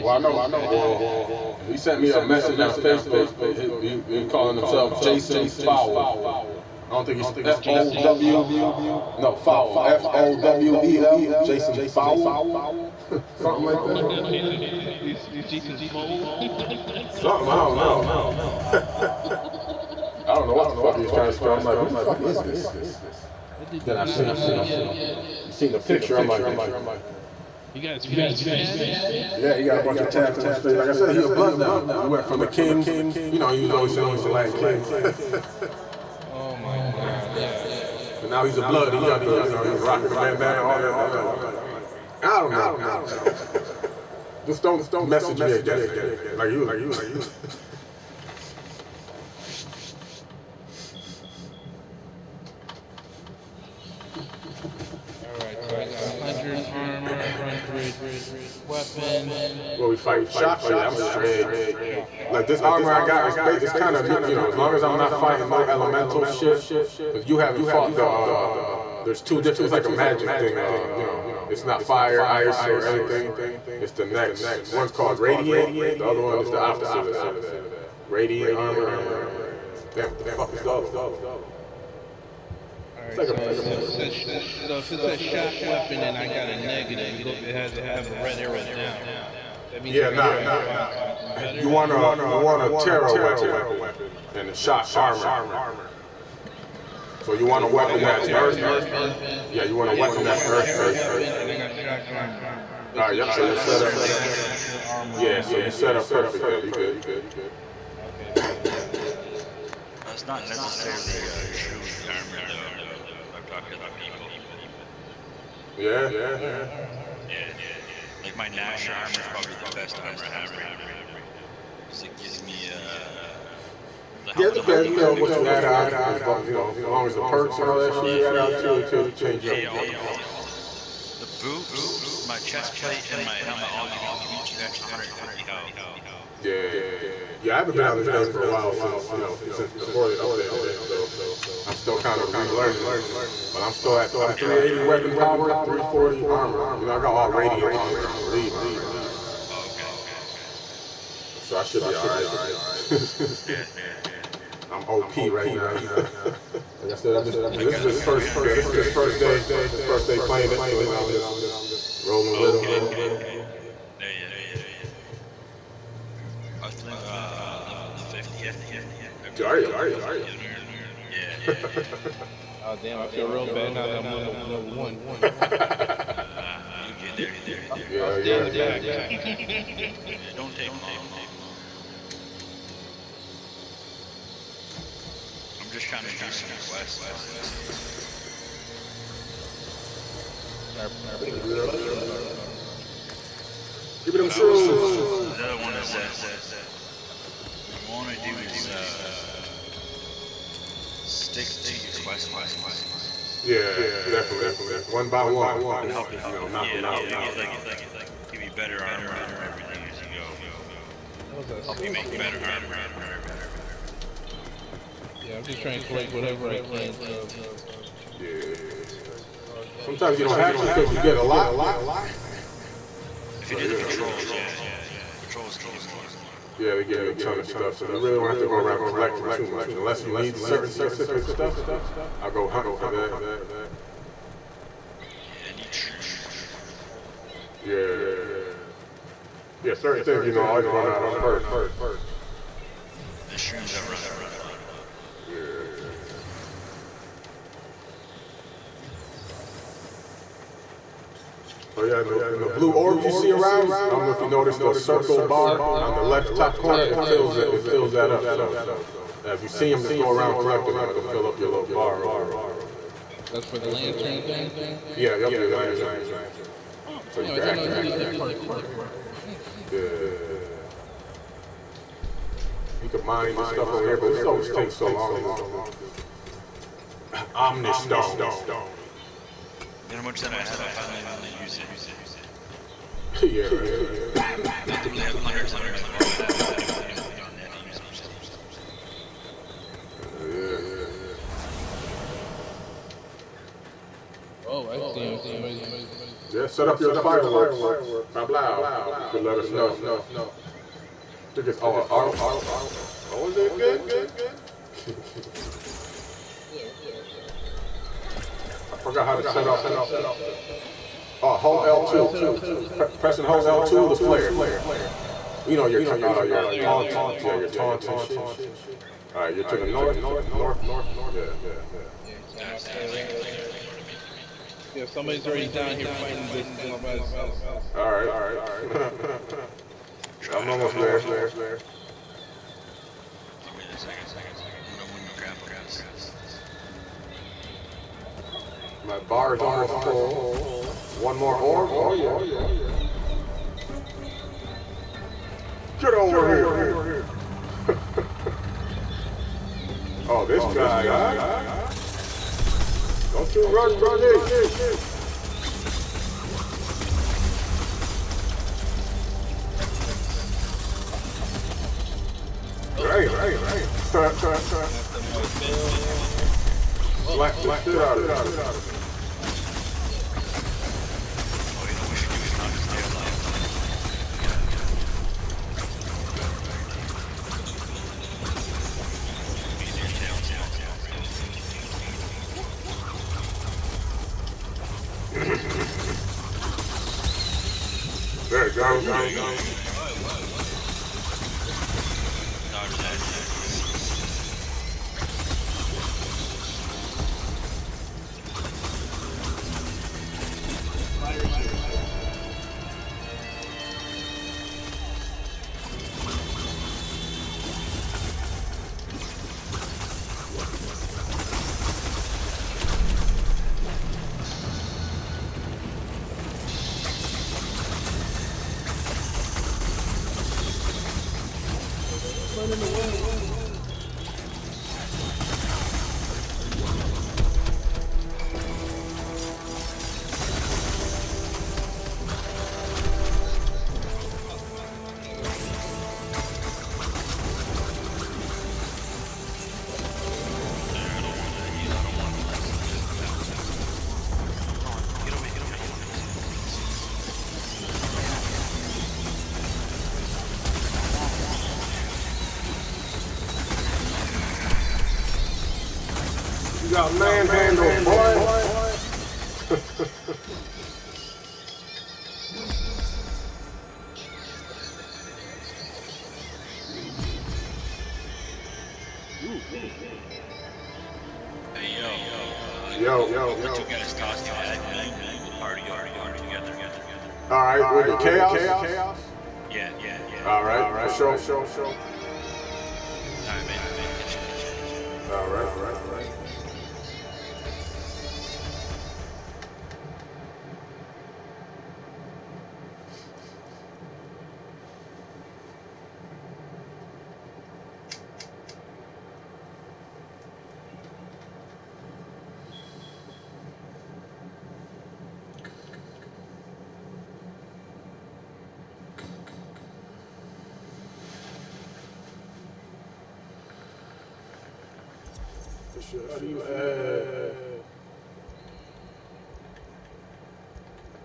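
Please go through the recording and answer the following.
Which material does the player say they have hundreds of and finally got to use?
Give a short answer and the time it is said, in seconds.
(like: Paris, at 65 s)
Omnistone, at 277 s.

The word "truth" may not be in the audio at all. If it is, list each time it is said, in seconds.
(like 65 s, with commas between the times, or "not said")
235 s.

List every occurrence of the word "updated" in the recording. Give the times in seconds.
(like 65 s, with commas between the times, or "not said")
140 s.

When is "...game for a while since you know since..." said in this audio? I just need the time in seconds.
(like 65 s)
138 s.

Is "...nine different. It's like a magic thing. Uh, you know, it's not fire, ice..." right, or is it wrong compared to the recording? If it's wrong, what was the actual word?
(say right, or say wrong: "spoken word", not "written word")
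wrong: "two", not "nine".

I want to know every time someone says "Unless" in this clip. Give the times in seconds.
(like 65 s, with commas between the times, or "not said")
229 s.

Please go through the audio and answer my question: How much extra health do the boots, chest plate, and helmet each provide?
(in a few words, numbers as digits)
150.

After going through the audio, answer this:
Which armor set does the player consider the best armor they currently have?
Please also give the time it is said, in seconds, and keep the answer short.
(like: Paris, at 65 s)
Gnasher armor, at 118 s.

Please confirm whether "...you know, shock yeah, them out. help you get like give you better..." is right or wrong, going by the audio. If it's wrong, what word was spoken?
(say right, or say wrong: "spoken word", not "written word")
wrong: "knock", not "shock".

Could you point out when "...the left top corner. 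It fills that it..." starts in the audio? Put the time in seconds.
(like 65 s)
255 s.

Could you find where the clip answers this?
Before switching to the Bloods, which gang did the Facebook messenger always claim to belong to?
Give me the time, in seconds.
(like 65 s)
34 s.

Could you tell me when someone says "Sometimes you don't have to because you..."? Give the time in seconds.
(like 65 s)
219 s.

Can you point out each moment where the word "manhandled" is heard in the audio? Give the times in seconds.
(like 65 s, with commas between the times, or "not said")
456 s.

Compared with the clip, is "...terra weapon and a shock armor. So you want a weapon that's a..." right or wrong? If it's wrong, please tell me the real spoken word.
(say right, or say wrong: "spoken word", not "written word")
right.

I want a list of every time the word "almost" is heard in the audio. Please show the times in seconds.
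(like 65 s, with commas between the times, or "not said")
330 s, 339 s.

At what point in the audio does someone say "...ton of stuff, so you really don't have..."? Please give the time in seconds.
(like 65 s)
227 s.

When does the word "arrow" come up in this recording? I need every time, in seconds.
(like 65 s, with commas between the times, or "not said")
88 s.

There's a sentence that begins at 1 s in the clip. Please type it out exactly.
He sent me a message on Facebook.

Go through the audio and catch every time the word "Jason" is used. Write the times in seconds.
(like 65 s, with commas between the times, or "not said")
4 s, 11 s, 15 s.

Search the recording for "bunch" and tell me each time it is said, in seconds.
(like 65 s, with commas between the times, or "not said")
29 s.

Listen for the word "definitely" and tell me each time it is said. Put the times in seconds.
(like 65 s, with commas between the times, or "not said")
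204 s.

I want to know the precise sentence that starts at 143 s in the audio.
But I'm still at I'm 380 yeah, weapon power, 340 armor.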